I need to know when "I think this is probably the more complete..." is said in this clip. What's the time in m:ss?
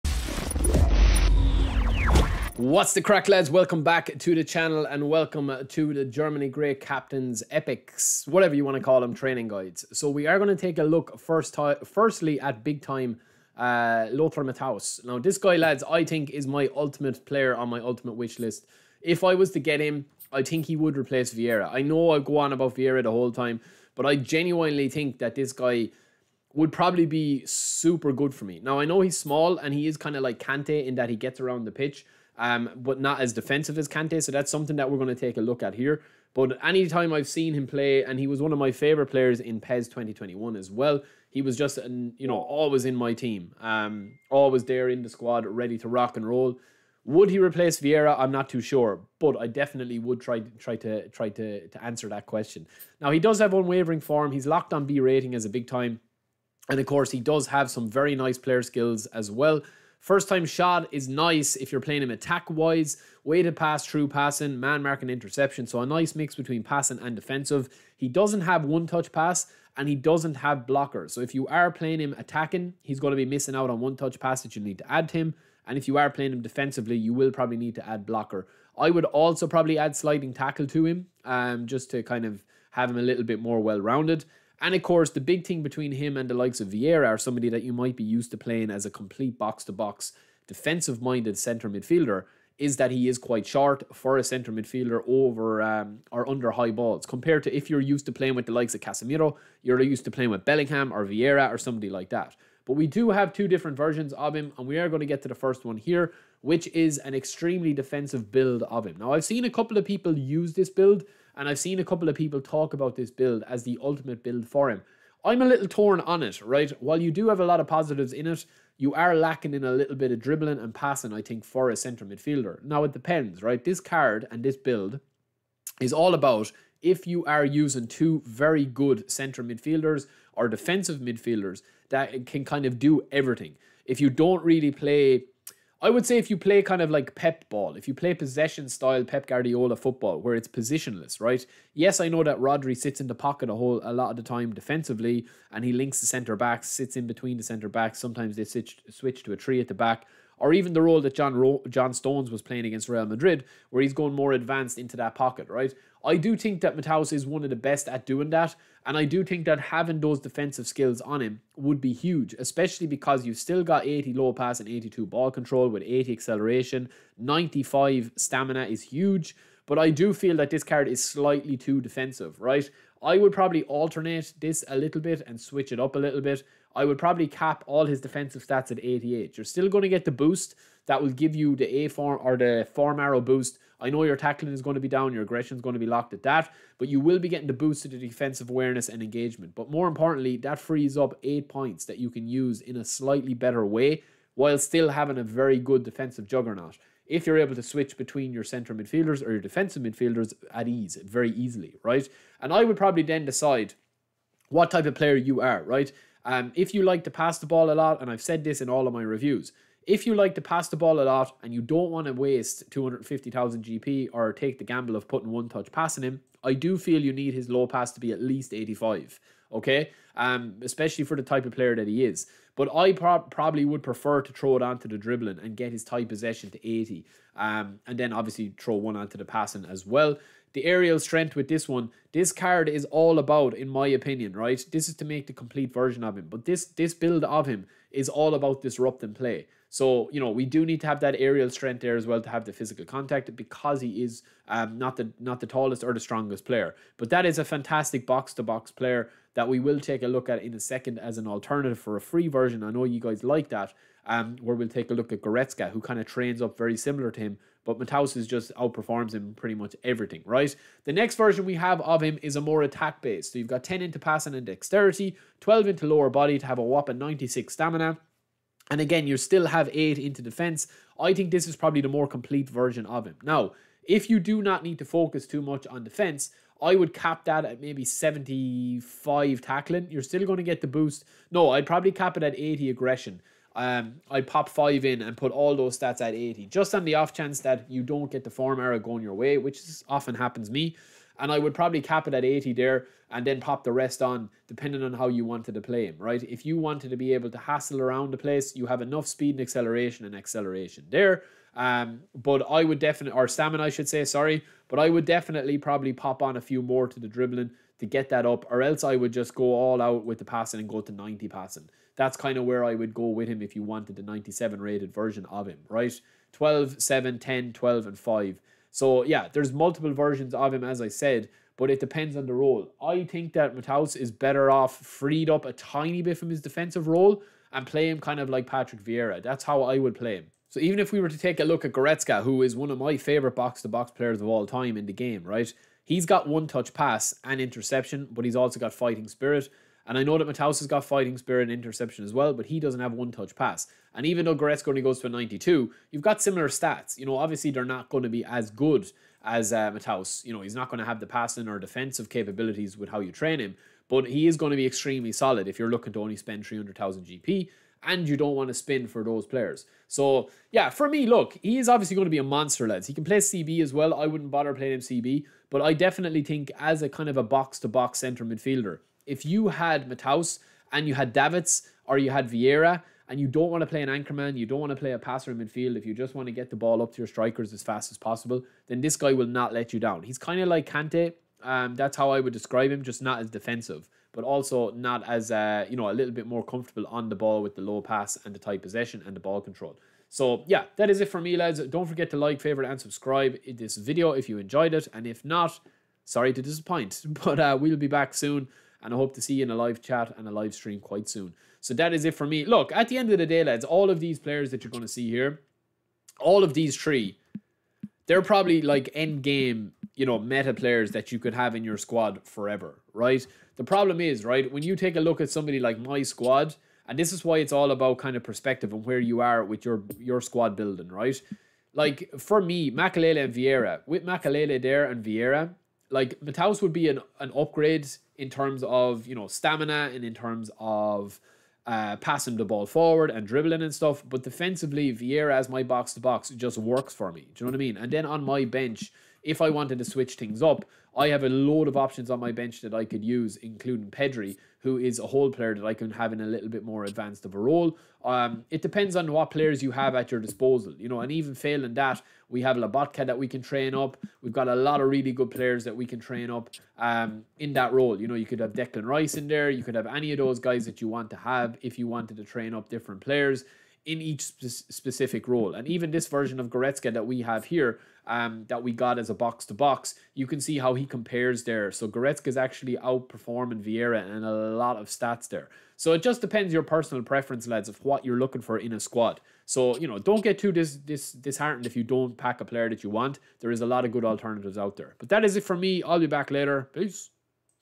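4:30.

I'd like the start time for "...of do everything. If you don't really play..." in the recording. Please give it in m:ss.
2:12.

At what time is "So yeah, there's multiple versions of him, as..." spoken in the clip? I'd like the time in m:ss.
5:18.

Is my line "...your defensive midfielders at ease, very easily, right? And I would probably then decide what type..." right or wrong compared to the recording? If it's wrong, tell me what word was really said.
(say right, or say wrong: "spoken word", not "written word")
right.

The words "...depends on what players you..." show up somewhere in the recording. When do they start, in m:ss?
7:28.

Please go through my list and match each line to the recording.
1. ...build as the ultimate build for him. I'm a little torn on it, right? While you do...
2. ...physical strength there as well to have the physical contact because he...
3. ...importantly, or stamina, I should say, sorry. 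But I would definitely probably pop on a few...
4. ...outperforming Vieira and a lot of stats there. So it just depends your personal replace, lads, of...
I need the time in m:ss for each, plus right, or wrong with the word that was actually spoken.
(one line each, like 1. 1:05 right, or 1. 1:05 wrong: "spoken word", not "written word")
1. 1:53 right
2. 4:01 wrong: "aerial", not "physical"
3. 5:02 wrong: "definitely", not "importantly"
4. 7:52 wrong: "preference", not "replace".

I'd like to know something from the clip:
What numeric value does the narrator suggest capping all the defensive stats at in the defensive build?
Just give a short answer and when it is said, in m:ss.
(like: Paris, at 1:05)
88, at 2:58.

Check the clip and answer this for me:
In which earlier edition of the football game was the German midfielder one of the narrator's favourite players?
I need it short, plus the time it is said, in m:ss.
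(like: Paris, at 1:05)
PES 2021, at 0:39.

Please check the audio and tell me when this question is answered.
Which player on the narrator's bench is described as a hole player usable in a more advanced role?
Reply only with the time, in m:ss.
7:23.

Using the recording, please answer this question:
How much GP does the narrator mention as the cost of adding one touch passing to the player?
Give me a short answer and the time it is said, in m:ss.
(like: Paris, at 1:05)
250,000 GP, at 3:32.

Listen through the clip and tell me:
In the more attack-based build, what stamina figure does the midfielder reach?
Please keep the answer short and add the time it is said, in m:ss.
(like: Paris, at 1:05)
96, at 4:26.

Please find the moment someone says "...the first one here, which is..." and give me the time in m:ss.
1:45.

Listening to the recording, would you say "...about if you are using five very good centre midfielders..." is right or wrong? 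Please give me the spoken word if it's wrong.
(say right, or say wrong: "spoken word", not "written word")
wrong: "two", not "five".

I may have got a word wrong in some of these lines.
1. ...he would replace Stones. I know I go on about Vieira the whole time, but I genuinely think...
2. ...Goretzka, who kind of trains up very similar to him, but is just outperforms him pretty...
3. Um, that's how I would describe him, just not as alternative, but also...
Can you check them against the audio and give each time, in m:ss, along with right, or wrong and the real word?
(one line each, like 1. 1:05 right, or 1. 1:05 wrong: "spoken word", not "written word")
1. 0:20 wrong: "Vieira", not "Stones"
2. 4:15 right
3. 6:21 wrong: "defensive", not "alternative".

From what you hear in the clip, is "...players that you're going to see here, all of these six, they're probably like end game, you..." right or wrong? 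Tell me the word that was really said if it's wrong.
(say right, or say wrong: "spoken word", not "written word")
wrong: "three", not "six".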